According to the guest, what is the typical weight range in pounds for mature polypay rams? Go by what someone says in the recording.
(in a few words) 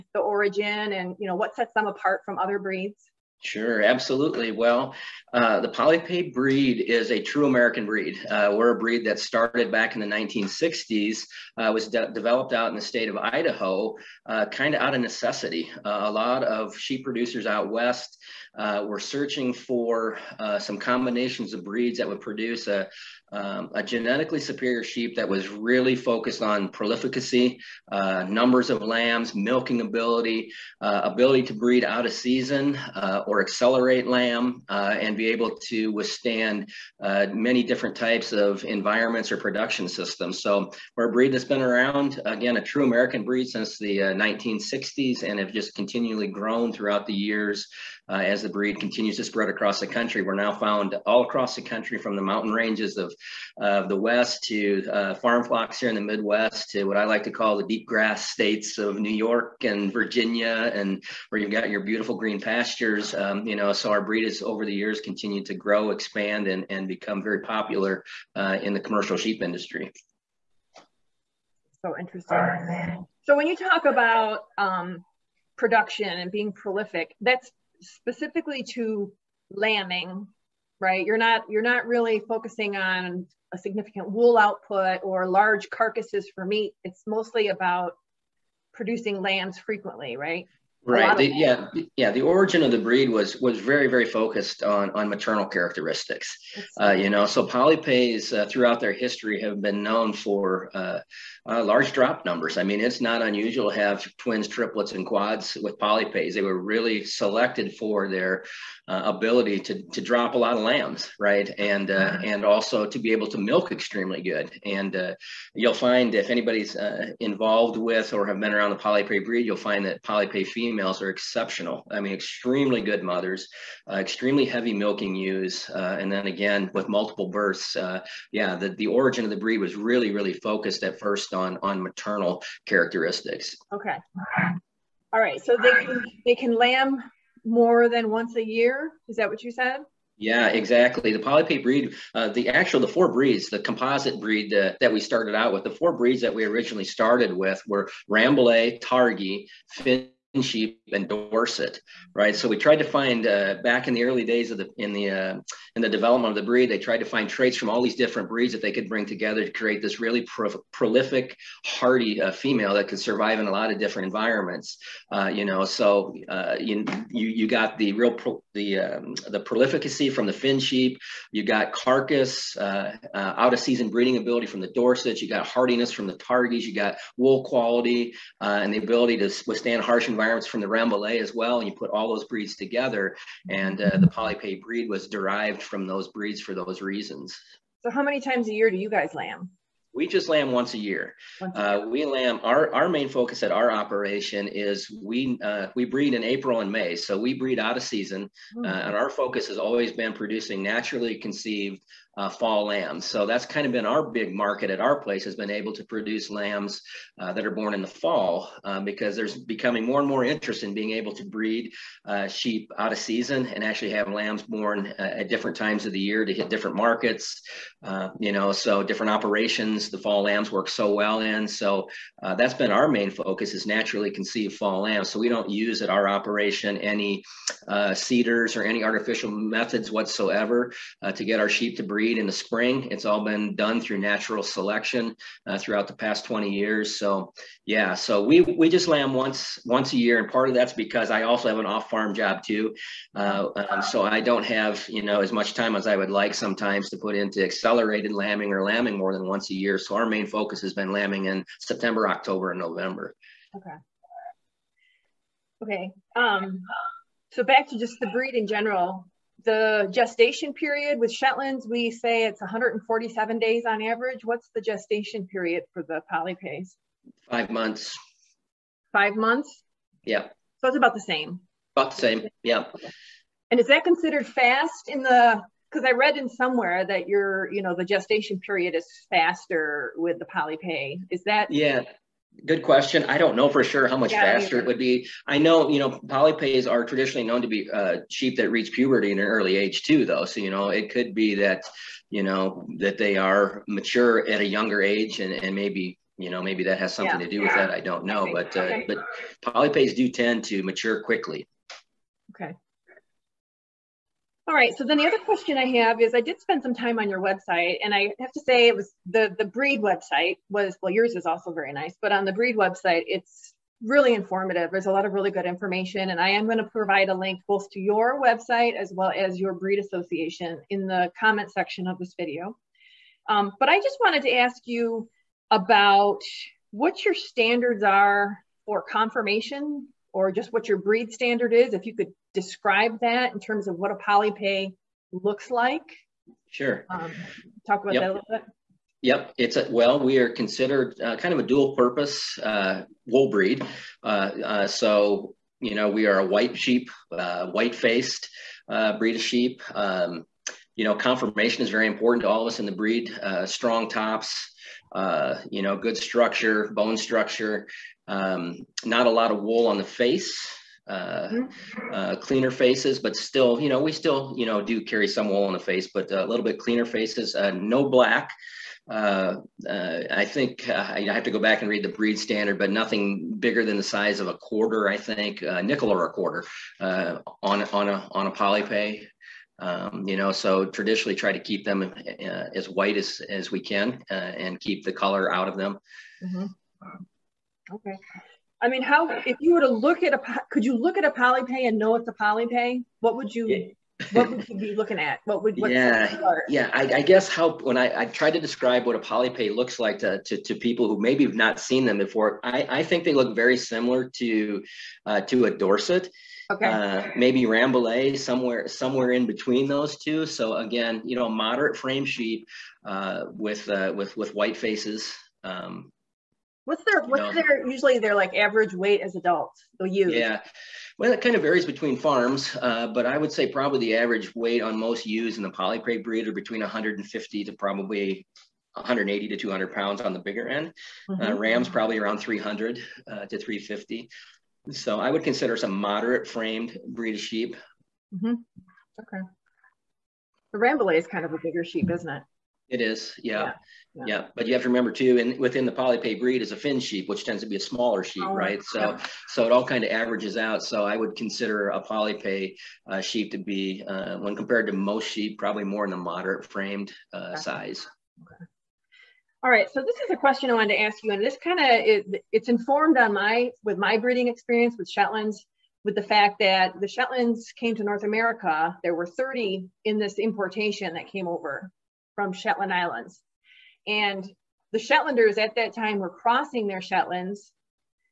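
300 to 350 pounds.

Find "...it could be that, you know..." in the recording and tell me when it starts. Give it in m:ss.
4:50.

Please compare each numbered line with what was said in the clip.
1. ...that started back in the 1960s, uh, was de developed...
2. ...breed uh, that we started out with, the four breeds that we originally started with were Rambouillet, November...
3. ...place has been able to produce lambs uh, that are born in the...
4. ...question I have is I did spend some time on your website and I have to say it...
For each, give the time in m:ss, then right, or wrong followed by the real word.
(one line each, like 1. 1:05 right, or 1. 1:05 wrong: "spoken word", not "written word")
1. 0:09 right
2. 2:24 wrong: "Targhee", not "November"
3. 3:25 right
4. 5:05 right.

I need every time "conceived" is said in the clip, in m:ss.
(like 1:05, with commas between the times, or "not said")
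3:21, 3:44.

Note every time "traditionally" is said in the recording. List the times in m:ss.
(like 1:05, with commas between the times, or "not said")
4:46, 6:20.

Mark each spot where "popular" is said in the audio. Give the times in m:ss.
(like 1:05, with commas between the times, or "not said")
1:07.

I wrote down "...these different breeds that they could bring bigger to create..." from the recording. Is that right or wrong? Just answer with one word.
wrong.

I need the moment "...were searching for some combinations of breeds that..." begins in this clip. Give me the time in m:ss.
0:18.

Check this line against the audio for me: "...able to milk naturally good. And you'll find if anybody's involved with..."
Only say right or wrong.
wrong.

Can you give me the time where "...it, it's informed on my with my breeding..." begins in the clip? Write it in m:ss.
7:41.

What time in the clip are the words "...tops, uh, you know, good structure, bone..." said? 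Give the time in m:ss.
5:53.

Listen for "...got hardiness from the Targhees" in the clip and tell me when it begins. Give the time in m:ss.
2:55.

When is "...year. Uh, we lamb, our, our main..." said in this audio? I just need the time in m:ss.
3:11.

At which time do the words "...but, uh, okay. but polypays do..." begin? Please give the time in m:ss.
4:58.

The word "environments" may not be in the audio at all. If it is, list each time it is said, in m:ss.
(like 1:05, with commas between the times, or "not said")
0:38, 2:44, 3:00.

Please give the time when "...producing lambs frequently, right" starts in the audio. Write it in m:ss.
1:28.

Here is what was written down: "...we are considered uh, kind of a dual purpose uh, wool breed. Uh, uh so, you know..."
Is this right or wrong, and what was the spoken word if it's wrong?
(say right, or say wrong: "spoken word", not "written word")
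right.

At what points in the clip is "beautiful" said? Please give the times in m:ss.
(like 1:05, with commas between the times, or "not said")
1:01.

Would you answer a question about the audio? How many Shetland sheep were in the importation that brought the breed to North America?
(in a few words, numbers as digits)
30.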